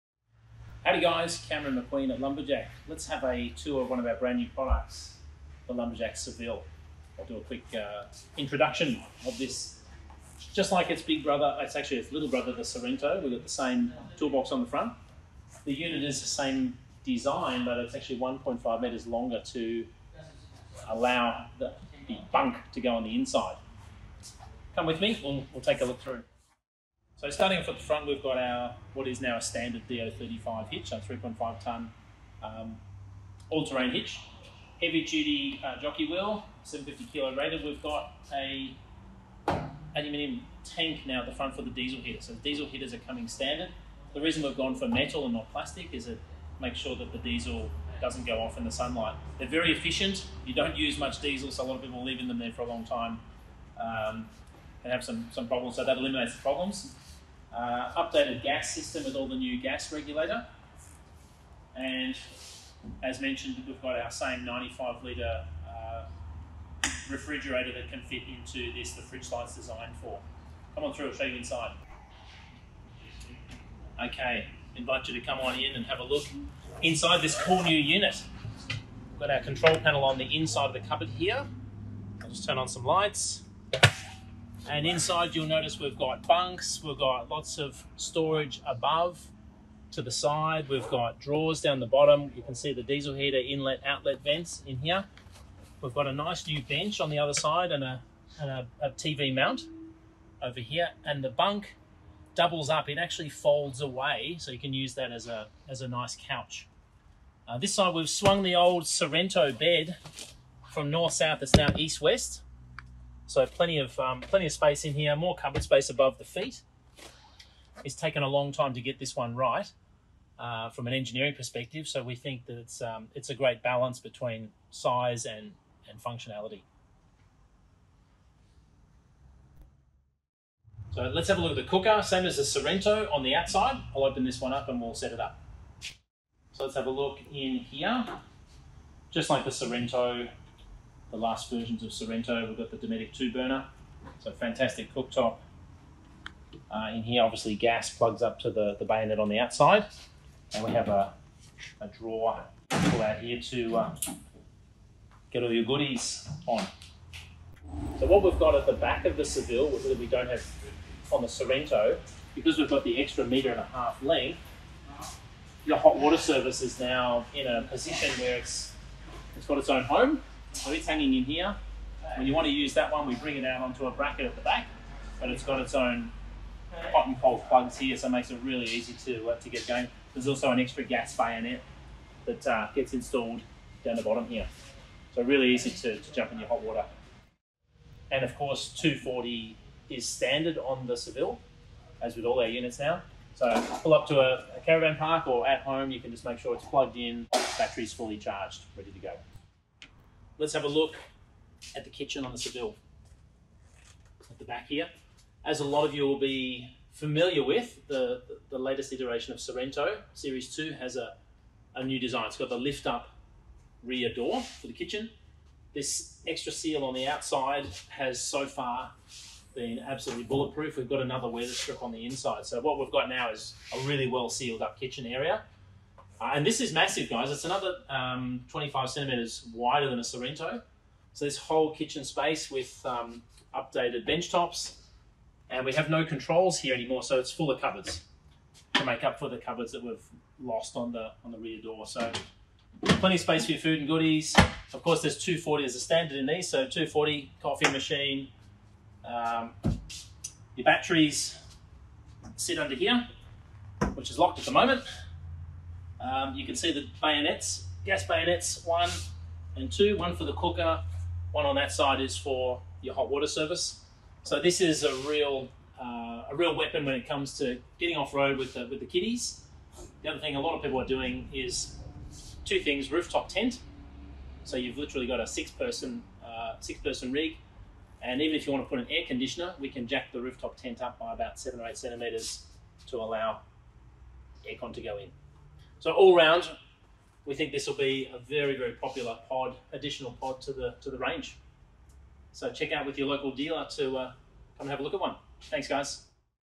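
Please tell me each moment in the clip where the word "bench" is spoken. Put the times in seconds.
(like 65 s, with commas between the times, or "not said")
96 s, 234 s.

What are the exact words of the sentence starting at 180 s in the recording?
There's also an extra gas bayonet that uh, gets installed down the bottom here.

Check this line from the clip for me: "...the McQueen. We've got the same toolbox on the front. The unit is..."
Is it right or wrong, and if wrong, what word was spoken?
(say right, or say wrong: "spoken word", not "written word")
wrong: "Sorrento", not "McQueen".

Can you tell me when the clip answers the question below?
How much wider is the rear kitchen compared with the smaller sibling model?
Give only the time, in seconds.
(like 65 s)
228 s.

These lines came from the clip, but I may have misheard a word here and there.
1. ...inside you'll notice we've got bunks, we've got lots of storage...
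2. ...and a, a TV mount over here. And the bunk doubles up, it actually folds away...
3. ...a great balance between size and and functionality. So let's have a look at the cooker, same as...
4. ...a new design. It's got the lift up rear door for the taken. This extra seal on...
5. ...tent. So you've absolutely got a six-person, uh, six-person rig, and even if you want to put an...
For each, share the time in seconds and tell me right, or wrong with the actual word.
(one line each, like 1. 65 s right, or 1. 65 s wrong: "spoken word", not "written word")
1. 84 s right
2. 98 s right
3. 123 s right
4. 211 s wrong: "kitchen", not "taken"
5. 273 s wrong: "literally", not "absolutely".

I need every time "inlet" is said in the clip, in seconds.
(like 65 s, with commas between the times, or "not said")
93 s.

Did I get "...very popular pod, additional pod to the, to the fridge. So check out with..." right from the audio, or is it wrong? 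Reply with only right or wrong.
wrong.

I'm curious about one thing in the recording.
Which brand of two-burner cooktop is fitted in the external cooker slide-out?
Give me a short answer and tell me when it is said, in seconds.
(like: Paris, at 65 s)
Dometic, at 142 s.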